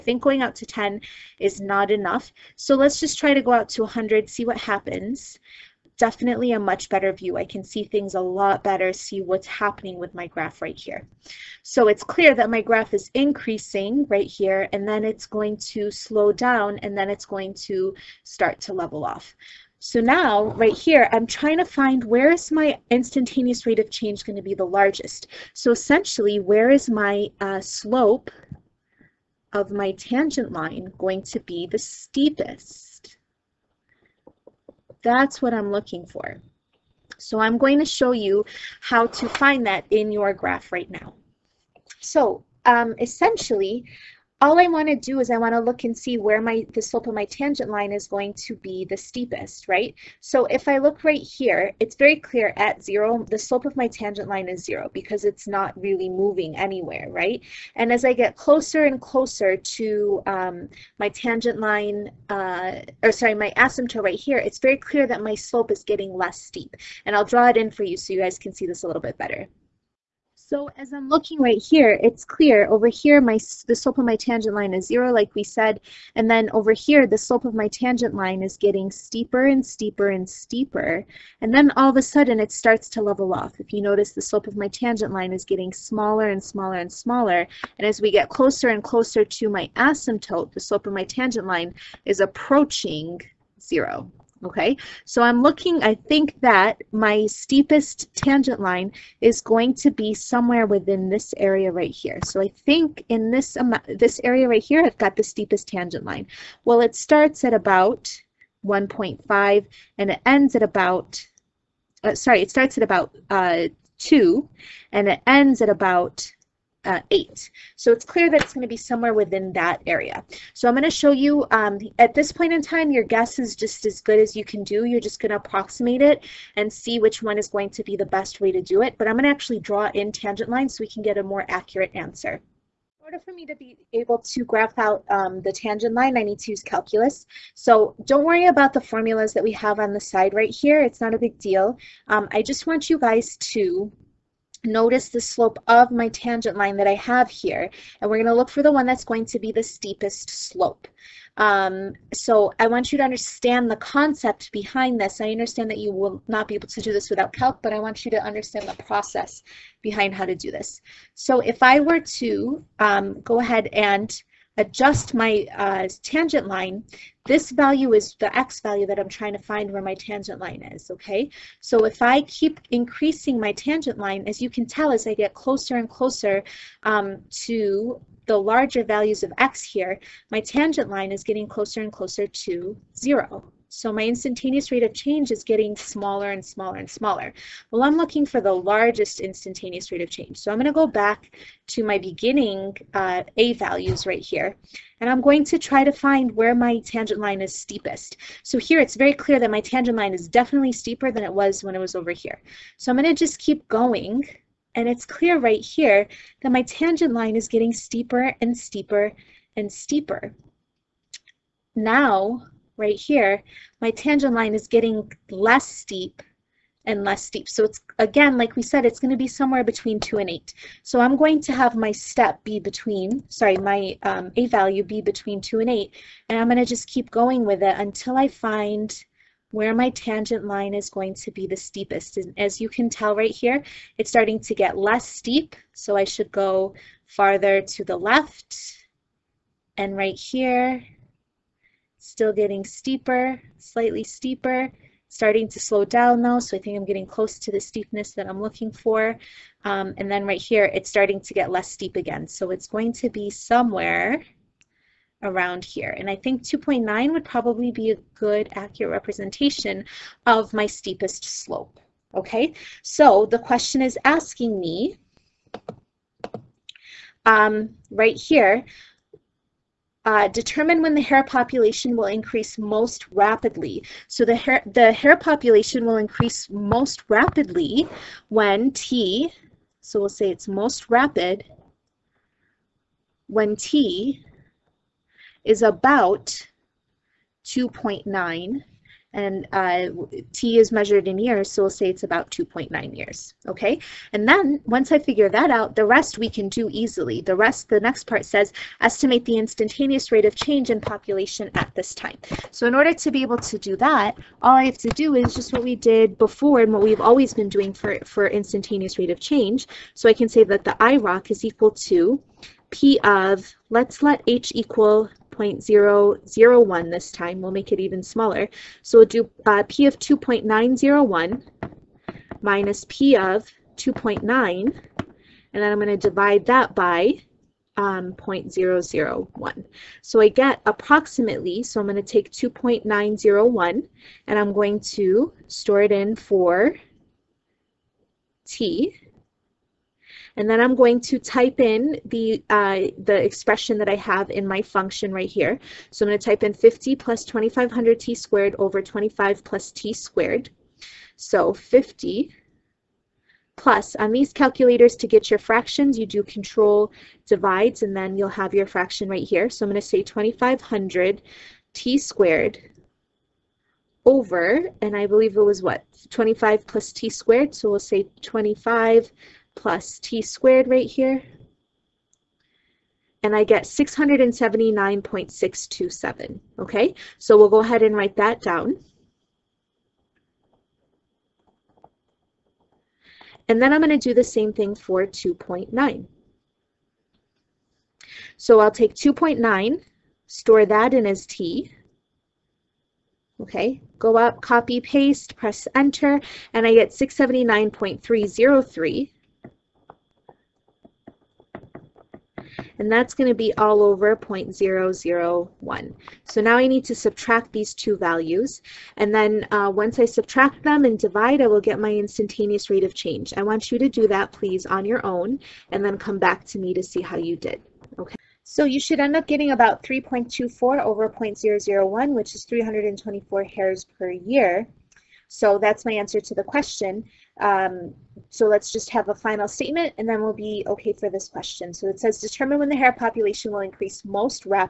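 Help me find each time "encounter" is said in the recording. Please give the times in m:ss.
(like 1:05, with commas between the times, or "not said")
not said.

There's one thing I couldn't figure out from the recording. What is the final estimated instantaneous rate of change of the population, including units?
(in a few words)
324 hares per year.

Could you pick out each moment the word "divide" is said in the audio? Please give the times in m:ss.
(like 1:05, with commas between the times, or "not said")
5:25, 5:57, 6:50.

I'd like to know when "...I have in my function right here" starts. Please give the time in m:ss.
5:43.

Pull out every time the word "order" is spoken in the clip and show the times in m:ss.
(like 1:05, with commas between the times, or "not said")
2:13, 5:02.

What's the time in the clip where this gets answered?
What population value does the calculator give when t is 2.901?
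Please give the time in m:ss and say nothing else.
6:13.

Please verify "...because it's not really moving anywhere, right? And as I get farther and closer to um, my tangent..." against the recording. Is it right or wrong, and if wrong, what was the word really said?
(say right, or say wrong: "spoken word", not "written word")
wrong: "closer", not "farther".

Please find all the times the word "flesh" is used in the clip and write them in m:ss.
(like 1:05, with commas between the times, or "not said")
not said.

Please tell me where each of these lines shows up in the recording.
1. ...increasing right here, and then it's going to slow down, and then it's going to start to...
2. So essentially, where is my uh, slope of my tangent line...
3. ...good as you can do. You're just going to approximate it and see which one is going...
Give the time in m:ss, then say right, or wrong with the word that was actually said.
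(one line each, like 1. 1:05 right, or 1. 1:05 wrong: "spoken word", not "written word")
1. 0:13 right
2. 0:25 right
3. 2:04 right.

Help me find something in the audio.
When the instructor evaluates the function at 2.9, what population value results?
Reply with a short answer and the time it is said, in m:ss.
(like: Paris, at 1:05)
679.303, at 6:36.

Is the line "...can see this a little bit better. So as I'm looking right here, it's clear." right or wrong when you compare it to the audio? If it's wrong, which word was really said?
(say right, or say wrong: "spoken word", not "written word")
right.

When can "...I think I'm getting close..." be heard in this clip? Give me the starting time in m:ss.
4:06.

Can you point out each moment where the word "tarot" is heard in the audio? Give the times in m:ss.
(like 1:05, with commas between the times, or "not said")
not said.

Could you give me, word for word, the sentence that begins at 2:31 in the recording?
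Um, so I want you to understand the concept behind this.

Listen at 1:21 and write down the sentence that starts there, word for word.
And then all of a sudden, it starts to level off.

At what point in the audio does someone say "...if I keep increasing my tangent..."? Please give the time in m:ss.
2:51.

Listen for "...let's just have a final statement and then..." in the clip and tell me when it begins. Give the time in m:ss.
7:08.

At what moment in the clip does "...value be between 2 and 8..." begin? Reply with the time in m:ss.
3:44.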